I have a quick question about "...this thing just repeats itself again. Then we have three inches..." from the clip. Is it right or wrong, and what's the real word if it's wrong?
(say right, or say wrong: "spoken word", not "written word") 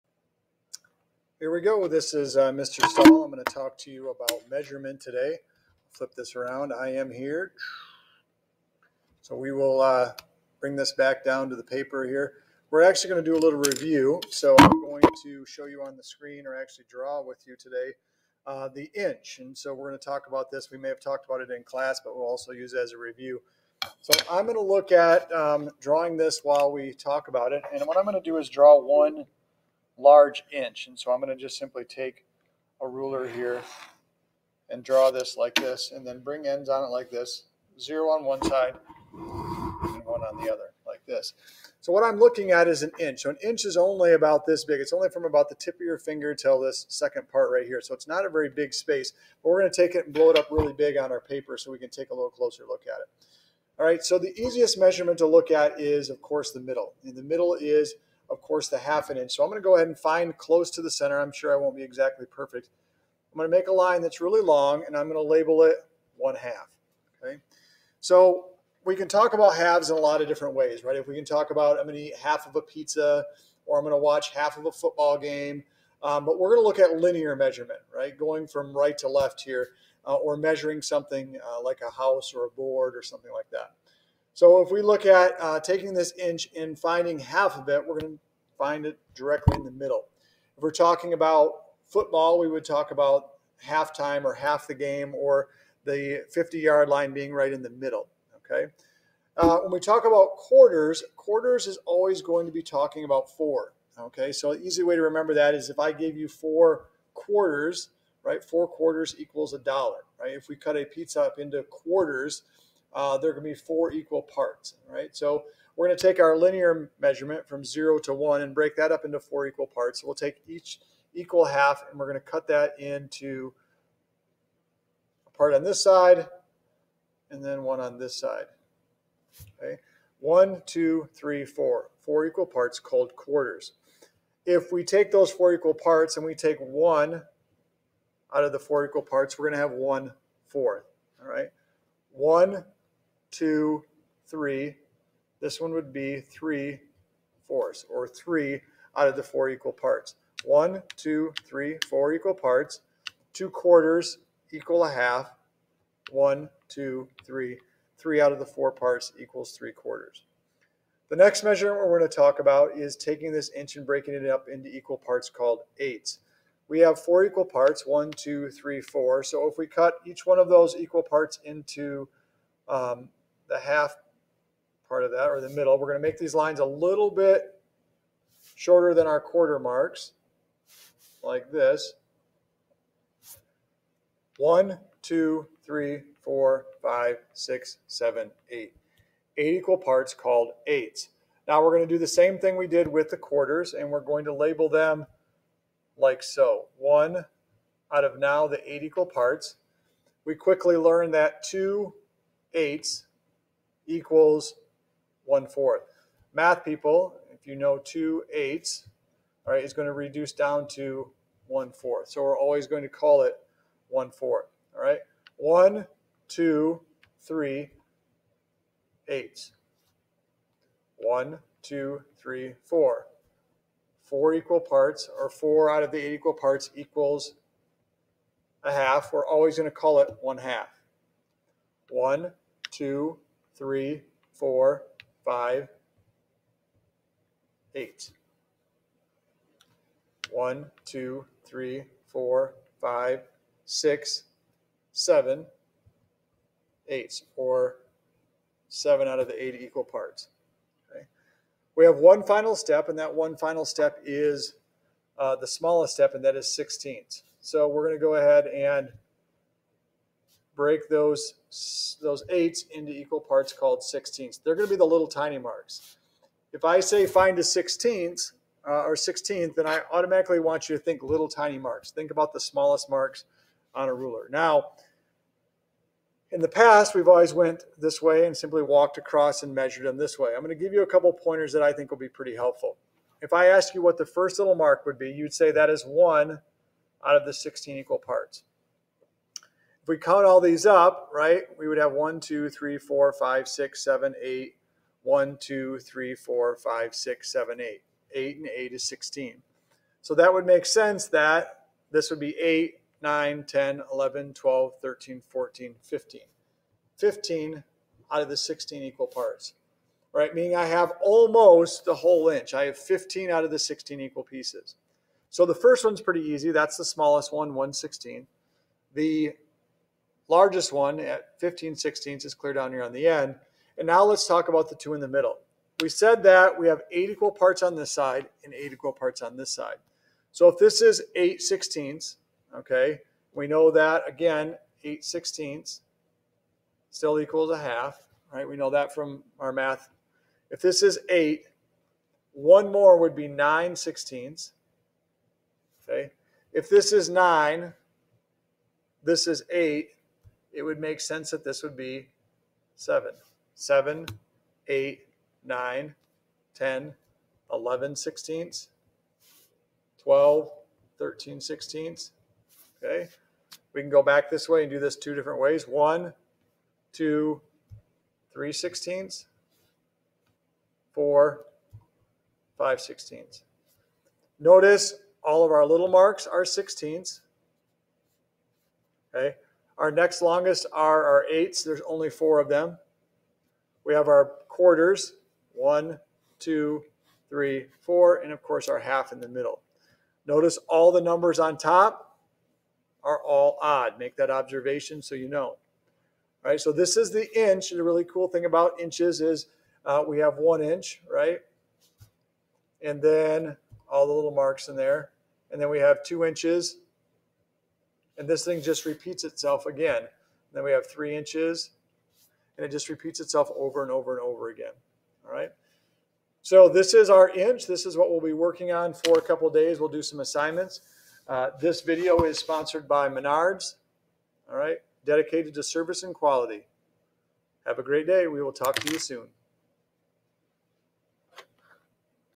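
right.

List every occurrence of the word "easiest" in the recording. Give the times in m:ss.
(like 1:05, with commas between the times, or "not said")
0:54.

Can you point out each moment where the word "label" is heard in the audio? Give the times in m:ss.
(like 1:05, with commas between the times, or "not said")
1:05, 3:14.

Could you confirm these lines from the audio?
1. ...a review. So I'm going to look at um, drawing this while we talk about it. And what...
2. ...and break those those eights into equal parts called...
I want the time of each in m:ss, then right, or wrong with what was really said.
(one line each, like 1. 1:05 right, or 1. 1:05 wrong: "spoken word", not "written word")
1. 0:22 right
2. 4:18 right.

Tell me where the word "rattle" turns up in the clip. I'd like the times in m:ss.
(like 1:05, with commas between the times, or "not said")
not said.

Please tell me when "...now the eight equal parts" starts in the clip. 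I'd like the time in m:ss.
3:18.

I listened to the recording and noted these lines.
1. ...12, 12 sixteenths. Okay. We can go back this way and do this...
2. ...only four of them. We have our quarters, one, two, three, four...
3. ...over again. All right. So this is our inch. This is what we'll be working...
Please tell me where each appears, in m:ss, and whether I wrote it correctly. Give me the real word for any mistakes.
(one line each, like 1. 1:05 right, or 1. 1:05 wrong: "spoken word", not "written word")
1. 6:00 wrong: "13", not "12"
2. 6:21 right
3. 6:54 right.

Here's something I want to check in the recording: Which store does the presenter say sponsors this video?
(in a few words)
Menards.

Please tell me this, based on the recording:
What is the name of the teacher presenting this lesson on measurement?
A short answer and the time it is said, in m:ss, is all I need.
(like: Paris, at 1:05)
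Mr. Stahl, at 0:02.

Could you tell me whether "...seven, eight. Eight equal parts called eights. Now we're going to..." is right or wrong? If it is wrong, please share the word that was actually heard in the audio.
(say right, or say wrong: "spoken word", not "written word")
right.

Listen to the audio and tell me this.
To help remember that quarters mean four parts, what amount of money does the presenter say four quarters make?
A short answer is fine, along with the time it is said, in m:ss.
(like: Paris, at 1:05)
a dollar, at 1:49.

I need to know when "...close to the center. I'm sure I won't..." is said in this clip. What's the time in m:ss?
1:00.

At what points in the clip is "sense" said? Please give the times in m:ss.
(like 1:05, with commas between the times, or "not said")
5:00, 5:50.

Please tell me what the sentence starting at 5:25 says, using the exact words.
We said that we have eight equal parts on this side and eight equal parts on this side.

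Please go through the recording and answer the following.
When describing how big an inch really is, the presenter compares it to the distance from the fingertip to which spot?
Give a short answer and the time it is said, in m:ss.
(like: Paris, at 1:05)
second part, at 0:46.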